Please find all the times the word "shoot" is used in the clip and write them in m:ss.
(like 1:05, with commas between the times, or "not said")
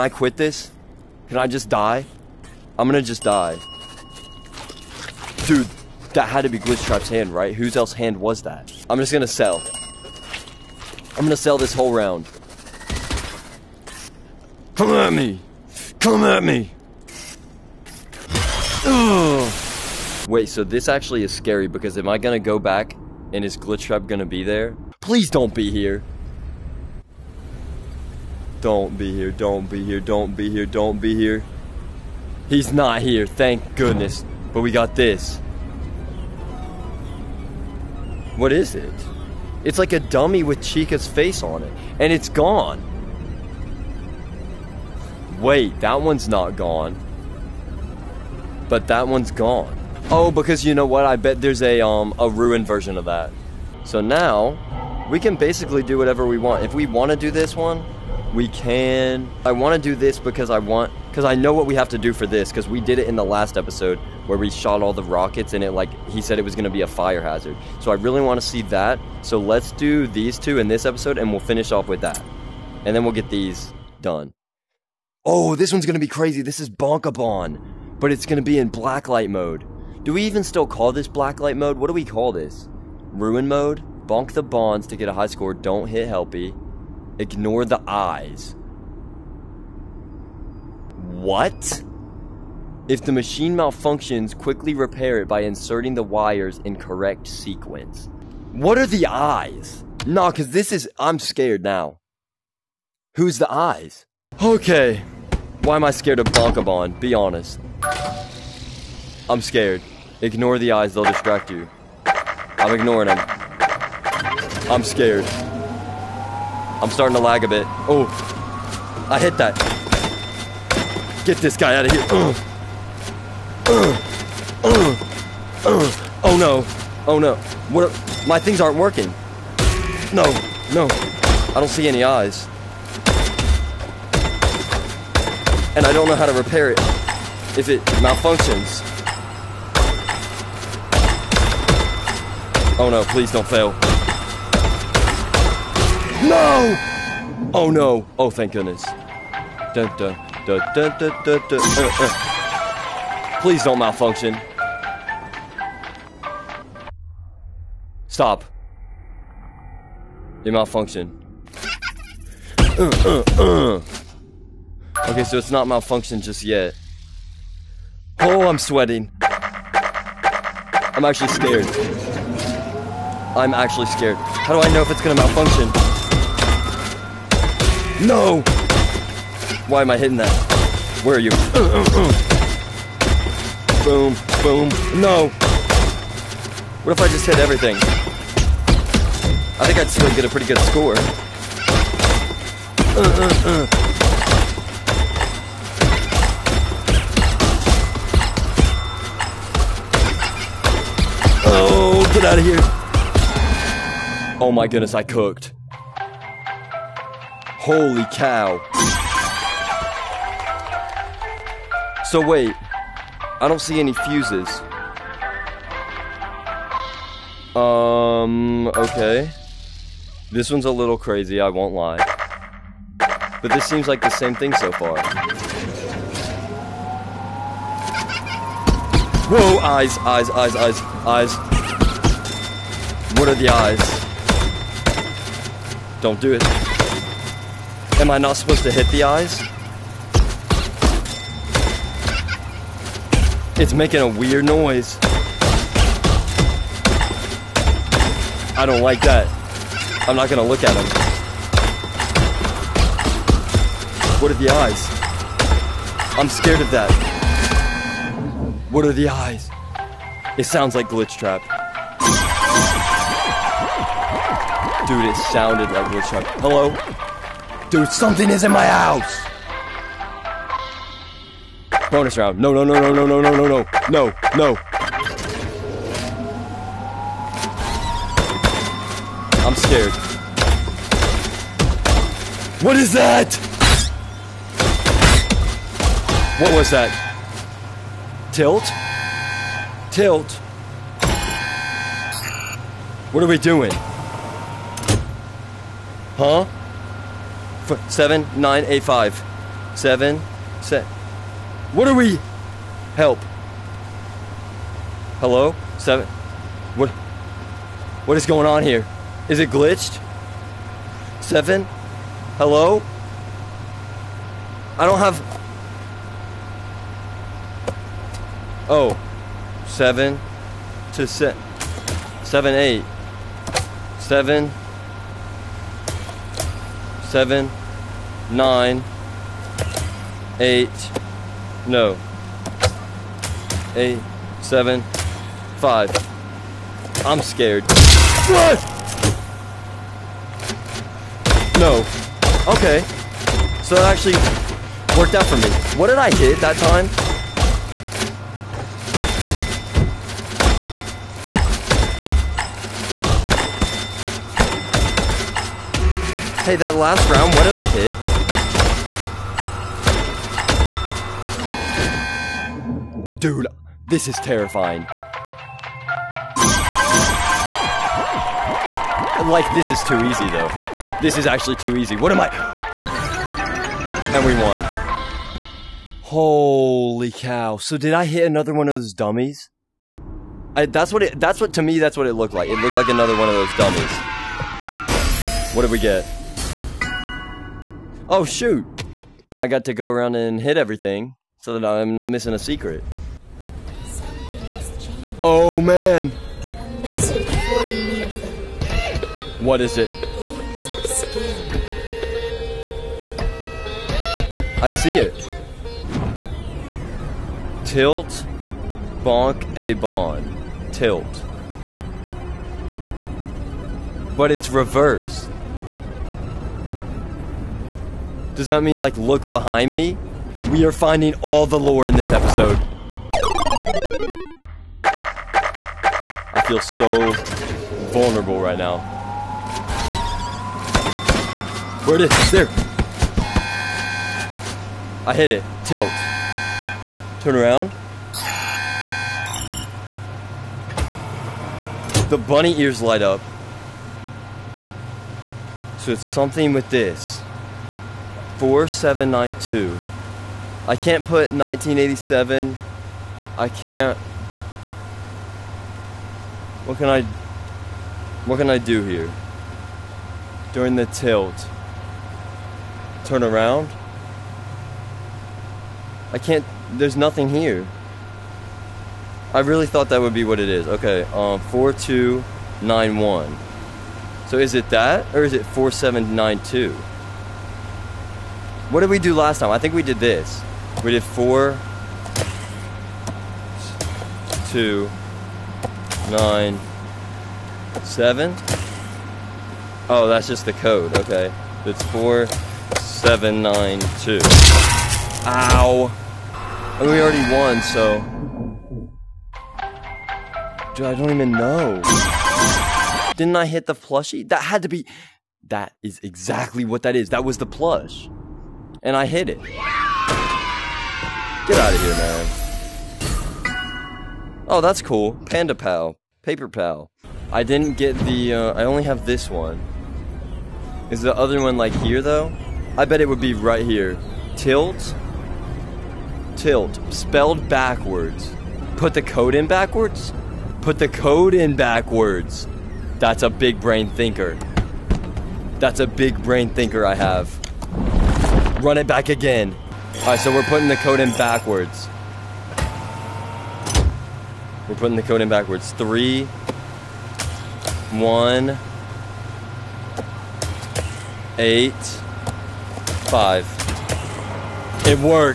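6:28.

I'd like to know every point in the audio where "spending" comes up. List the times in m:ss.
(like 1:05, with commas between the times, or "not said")
not said.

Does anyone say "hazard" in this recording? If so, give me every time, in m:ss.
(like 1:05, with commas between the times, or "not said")
1:07.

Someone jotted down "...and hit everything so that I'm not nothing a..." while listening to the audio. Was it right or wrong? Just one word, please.
wrong.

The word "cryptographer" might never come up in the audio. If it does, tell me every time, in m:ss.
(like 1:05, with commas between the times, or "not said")
not said.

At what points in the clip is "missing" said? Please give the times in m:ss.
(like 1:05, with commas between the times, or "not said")
6:32.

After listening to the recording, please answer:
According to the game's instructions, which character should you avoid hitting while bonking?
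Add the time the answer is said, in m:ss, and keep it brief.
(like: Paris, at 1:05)
Helpy, at 1:25.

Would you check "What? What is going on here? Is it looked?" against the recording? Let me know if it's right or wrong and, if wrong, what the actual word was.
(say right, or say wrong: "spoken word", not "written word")
wrong: "glitched", not "looked".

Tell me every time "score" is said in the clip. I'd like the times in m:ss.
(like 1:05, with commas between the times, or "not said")
1:25, 3:10.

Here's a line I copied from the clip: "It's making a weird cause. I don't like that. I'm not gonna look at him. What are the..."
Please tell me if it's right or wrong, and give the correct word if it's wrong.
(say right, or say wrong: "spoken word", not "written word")
wrong: "noise", not "cause".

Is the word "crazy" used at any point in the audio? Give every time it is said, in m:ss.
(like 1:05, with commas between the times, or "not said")
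1:16, 3:40.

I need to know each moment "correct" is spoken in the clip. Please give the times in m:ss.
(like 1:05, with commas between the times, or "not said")
1:36.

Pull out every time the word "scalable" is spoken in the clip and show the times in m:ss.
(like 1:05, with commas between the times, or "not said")
not said.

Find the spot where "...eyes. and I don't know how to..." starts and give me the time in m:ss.
2:12.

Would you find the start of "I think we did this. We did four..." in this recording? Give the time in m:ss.
7:59.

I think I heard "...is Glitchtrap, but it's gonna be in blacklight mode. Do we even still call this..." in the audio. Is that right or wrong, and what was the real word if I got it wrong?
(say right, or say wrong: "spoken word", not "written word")
wrong: "Bonkabon", not "Glitchtrap".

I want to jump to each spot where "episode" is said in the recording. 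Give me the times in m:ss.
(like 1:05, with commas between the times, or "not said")
1:03, 1:10, 7:02.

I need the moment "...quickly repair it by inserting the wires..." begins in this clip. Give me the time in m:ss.
1:34.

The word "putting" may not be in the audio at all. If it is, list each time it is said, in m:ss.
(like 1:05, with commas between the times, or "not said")
9:00, 9:04.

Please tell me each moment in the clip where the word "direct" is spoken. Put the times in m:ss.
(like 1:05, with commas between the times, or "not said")
not said.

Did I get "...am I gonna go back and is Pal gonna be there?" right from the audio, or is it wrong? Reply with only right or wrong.
wrong.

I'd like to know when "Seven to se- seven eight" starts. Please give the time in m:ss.
5:19.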